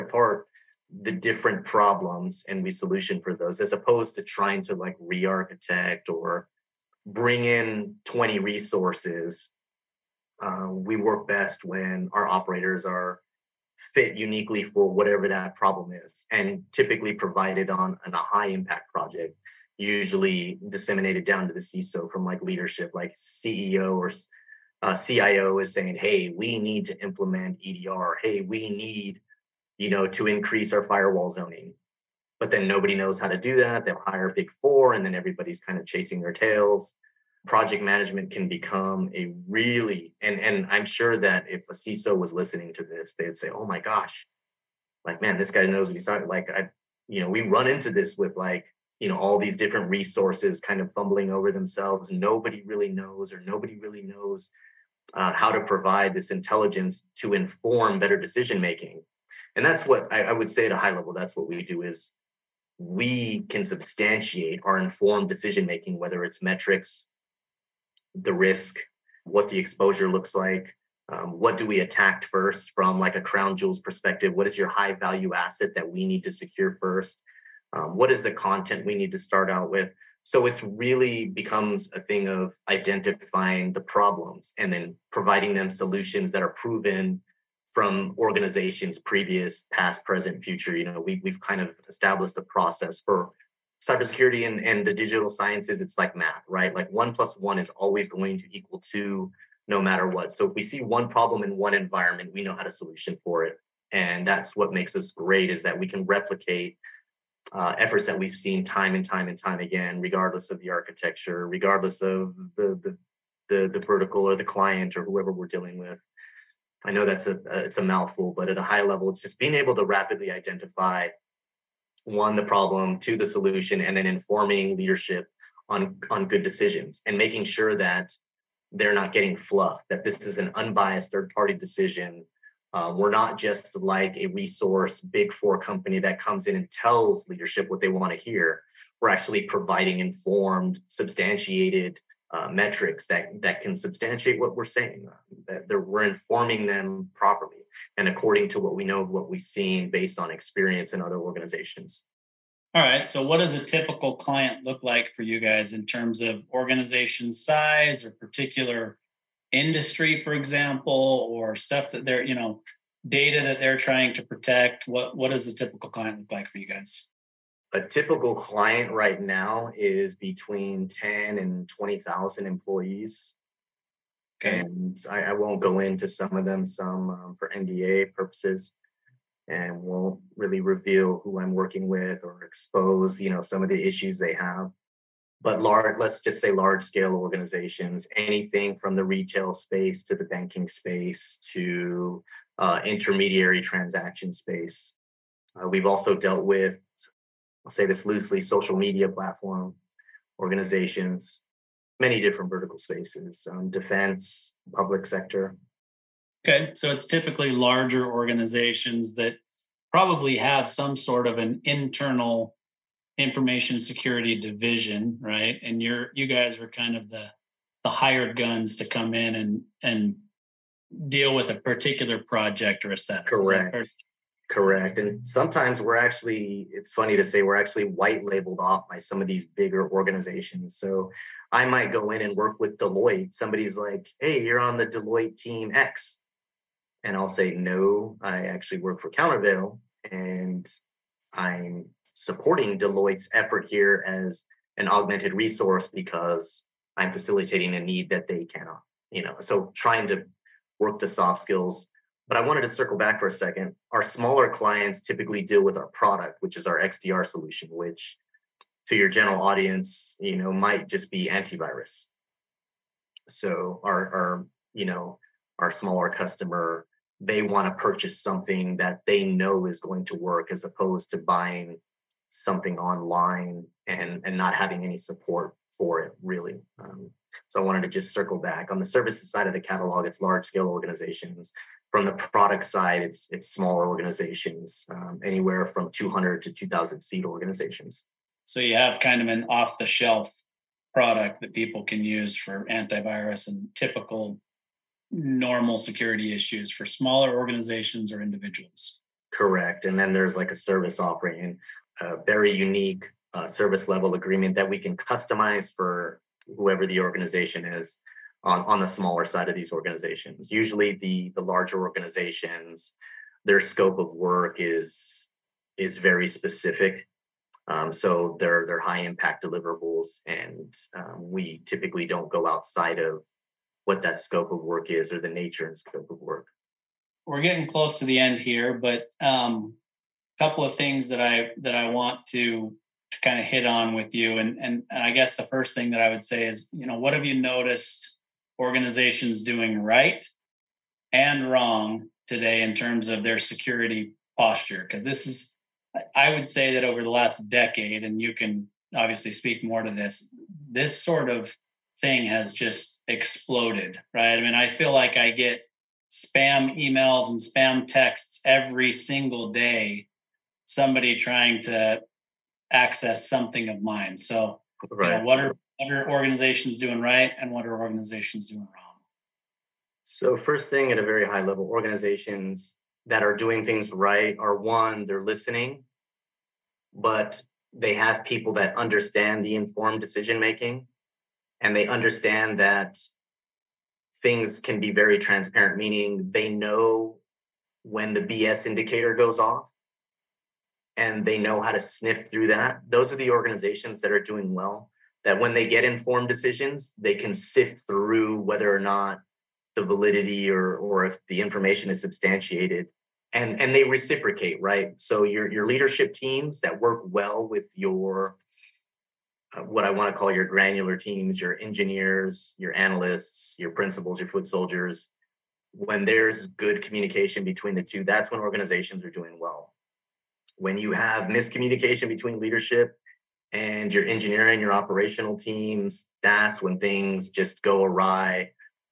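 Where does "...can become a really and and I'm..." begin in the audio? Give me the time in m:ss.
0:38.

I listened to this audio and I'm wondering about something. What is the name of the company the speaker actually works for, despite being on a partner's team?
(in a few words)
Counterveil.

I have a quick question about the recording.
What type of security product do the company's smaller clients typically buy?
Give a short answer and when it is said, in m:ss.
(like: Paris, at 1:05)
XDR solution, at 4:16.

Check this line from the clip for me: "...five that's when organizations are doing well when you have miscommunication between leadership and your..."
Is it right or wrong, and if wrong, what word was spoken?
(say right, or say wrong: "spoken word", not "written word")
wrong: "two", not "five".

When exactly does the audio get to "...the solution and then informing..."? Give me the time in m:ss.
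2:03.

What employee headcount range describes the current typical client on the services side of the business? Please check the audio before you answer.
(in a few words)
10 to 20,000.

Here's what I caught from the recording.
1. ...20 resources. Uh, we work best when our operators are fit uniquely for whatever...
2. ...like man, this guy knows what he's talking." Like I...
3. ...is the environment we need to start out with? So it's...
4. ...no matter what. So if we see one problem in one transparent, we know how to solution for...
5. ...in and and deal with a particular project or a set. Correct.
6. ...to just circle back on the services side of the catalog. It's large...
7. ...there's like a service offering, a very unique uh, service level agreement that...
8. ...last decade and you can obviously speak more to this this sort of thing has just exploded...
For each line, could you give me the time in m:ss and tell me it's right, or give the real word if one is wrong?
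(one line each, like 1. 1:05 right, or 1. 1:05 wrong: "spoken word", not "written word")
1. 0:08 right
2. 0:45 right
3. 1:18 wrong: "content", not "environment"
4. 1:39 wrong: "environment", not "transparent"
5. 3:39 right
6. 4:37 right
7. 5:00 right
8. 5:47 right.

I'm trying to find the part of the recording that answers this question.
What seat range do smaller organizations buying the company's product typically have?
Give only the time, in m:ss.
4:45.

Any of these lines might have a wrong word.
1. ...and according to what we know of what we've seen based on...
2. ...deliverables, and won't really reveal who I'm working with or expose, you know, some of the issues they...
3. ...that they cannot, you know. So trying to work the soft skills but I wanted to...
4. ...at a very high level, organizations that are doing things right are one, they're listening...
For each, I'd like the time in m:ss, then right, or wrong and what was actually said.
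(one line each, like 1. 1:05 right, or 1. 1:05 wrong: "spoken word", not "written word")
1. 2:27 right
2. 2:58 wrong: "purposes", not "deliverables"
3. 4:08 right
4. 6:10 right.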